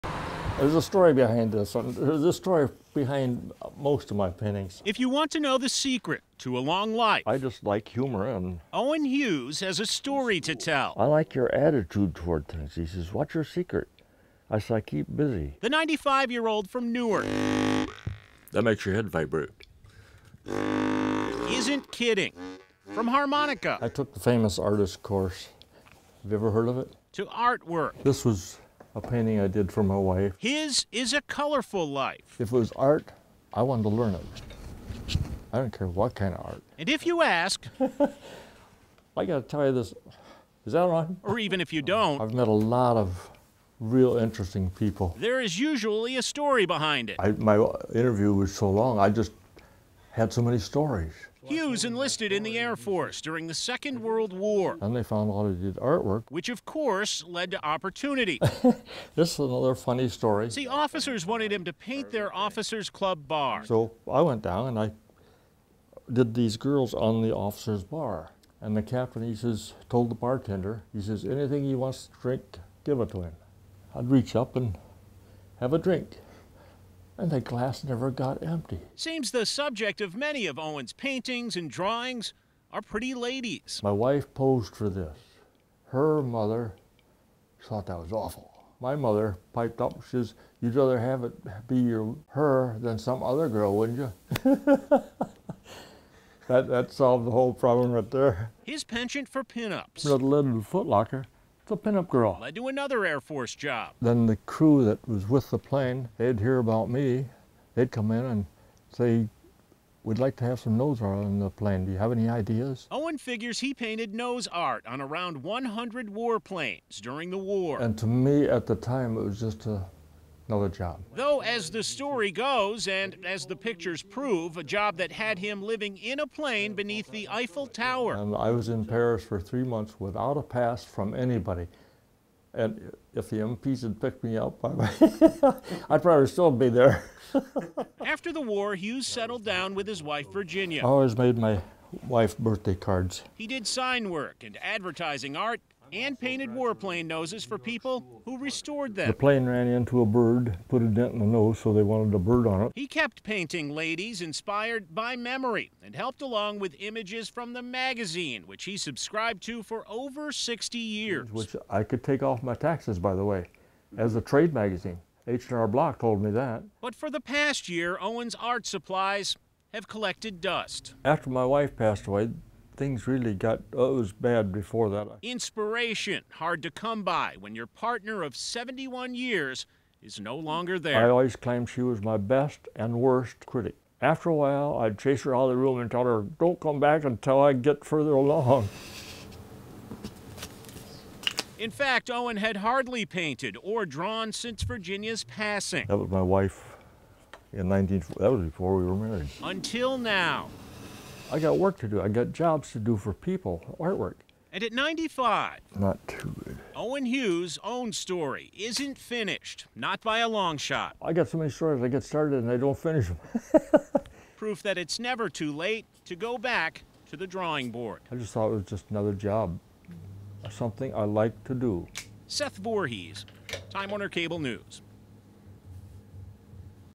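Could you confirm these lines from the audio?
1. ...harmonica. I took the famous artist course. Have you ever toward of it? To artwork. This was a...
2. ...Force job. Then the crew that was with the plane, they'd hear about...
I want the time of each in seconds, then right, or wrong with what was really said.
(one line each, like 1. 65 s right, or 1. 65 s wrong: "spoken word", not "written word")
1. 23 s wrong: "heard", not "toward"
2. 103 s right.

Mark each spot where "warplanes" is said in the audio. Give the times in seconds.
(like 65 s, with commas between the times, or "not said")
116 s, 146 s.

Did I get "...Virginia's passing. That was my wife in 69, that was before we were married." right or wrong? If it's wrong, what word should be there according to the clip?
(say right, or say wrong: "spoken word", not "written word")
wrong: "19", not "69".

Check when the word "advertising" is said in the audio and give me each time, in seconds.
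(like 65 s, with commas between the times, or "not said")
144 s.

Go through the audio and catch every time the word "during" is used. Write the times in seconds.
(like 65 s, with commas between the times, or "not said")
53 s, 117 s.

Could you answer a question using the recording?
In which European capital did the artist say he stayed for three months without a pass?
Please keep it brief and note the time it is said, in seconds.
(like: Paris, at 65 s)
Paris, at 128 s.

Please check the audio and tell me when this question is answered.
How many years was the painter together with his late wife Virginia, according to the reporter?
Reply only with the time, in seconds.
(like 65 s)
178 s.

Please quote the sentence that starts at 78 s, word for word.
Seems the subject of many of Owen's paintings and drawings are pretty ladies.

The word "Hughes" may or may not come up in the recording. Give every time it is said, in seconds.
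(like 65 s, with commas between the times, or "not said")
9 s, 51 s, 138 s, 207 s.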